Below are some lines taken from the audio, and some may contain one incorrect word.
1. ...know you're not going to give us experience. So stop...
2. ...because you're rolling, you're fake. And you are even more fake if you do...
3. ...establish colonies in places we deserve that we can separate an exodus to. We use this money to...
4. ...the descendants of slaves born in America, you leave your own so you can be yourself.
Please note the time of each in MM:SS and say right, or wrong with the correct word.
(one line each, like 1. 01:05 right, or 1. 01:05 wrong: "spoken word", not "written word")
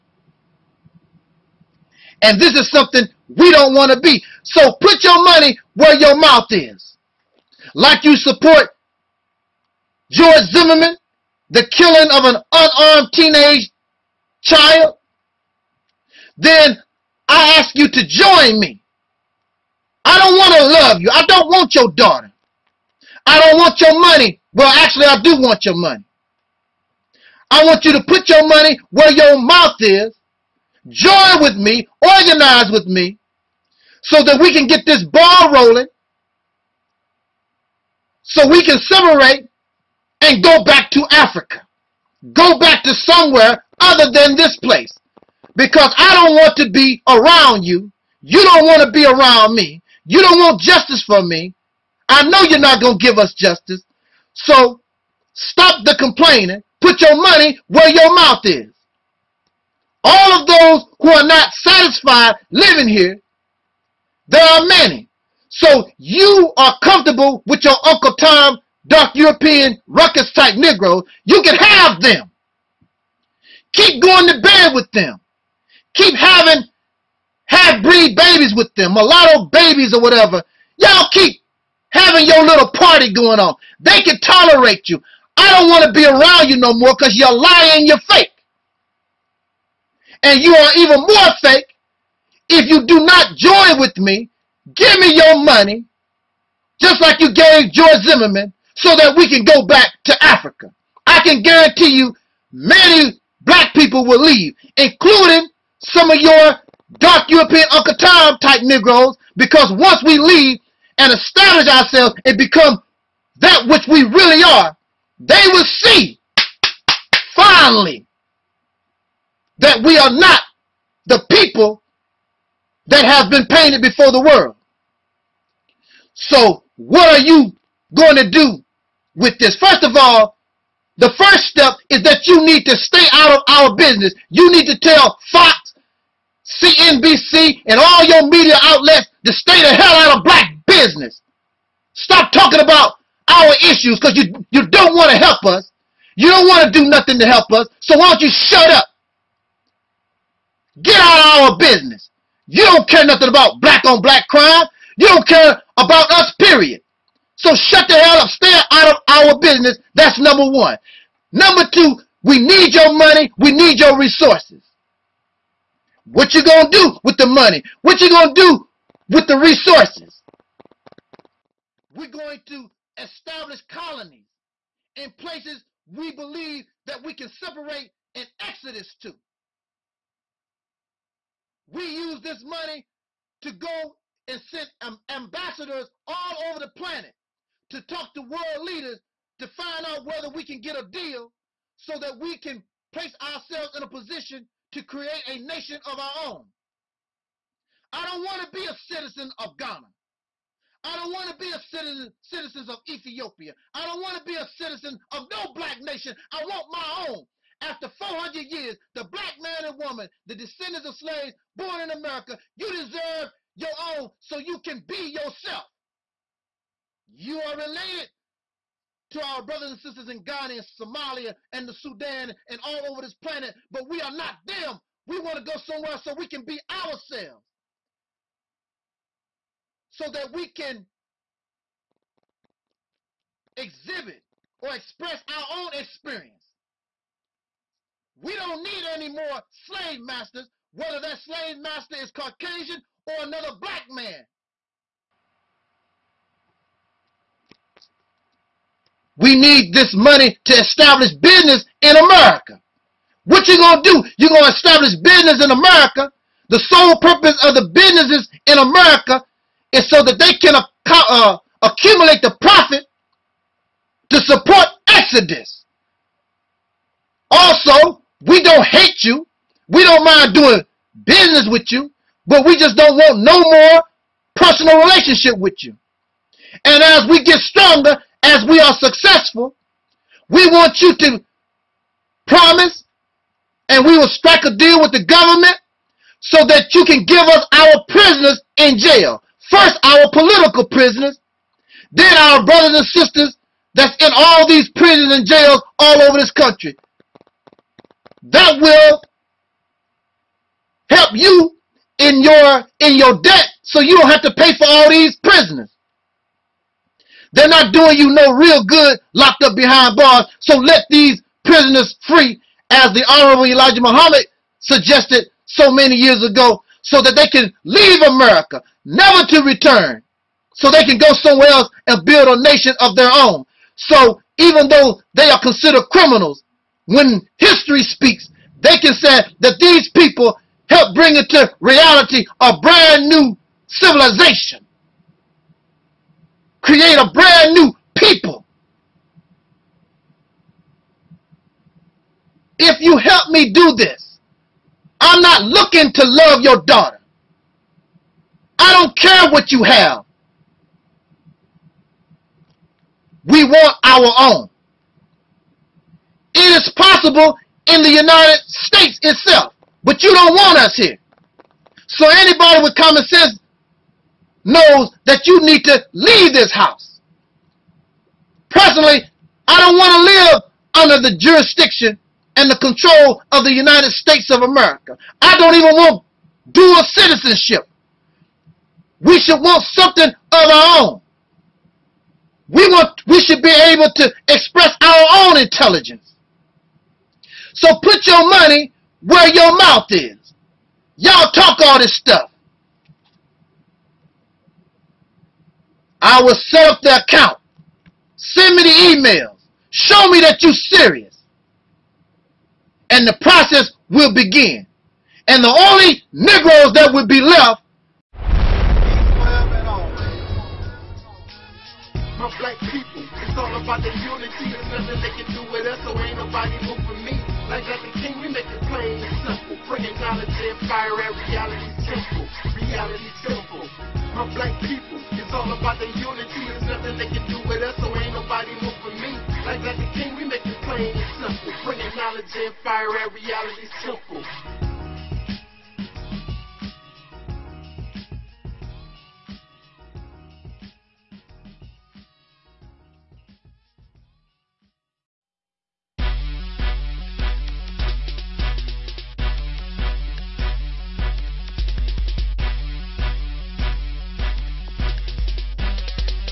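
1. 00:52 wrong: "justice", not "experience"
2. 01:26 wrong: "lying", not "rolling"
3. 02:52 wrong: "believe", not "deserve"
4. 03:30 wrong: "deserve", not "leave".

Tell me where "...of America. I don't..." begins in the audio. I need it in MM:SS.
06:14.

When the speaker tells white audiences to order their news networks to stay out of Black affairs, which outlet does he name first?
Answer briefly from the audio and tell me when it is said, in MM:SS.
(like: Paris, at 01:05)
Fox, at 02:15.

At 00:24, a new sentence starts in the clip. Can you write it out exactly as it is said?
Well, actually, I do want your money.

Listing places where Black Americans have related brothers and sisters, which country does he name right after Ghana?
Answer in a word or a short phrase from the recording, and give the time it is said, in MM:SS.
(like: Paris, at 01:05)
Somalia, at 03:40.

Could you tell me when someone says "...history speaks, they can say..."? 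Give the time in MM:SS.
05:27.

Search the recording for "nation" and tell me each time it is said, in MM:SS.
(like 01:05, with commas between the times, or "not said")
03:15, 03:25, 05:22.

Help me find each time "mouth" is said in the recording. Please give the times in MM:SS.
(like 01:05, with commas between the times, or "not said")
00:06, 00:29, 00:58, 06:29.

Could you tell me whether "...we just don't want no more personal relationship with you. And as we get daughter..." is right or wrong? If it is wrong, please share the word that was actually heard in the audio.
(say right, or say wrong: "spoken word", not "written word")
wrong: "stronger", not "daughter".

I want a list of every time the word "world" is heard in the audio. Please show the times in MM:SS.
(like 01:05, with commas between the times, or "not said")
02:04, 03:08.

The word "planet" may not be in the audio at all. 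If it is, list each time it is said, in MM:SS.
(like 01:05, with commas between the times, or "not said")
03:06, 03:43.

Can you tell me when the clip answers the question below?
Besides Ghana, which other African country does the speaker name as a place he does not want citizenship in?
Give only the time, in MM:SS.
03:22.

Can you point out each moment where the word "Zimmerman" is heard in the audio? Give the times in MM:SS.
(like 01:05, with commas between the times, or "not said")
00:10, 01:38.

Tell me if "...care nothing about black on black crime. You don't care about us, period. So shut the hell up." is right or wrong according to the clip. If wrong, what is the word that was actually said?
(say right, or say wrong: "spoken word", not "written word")
right.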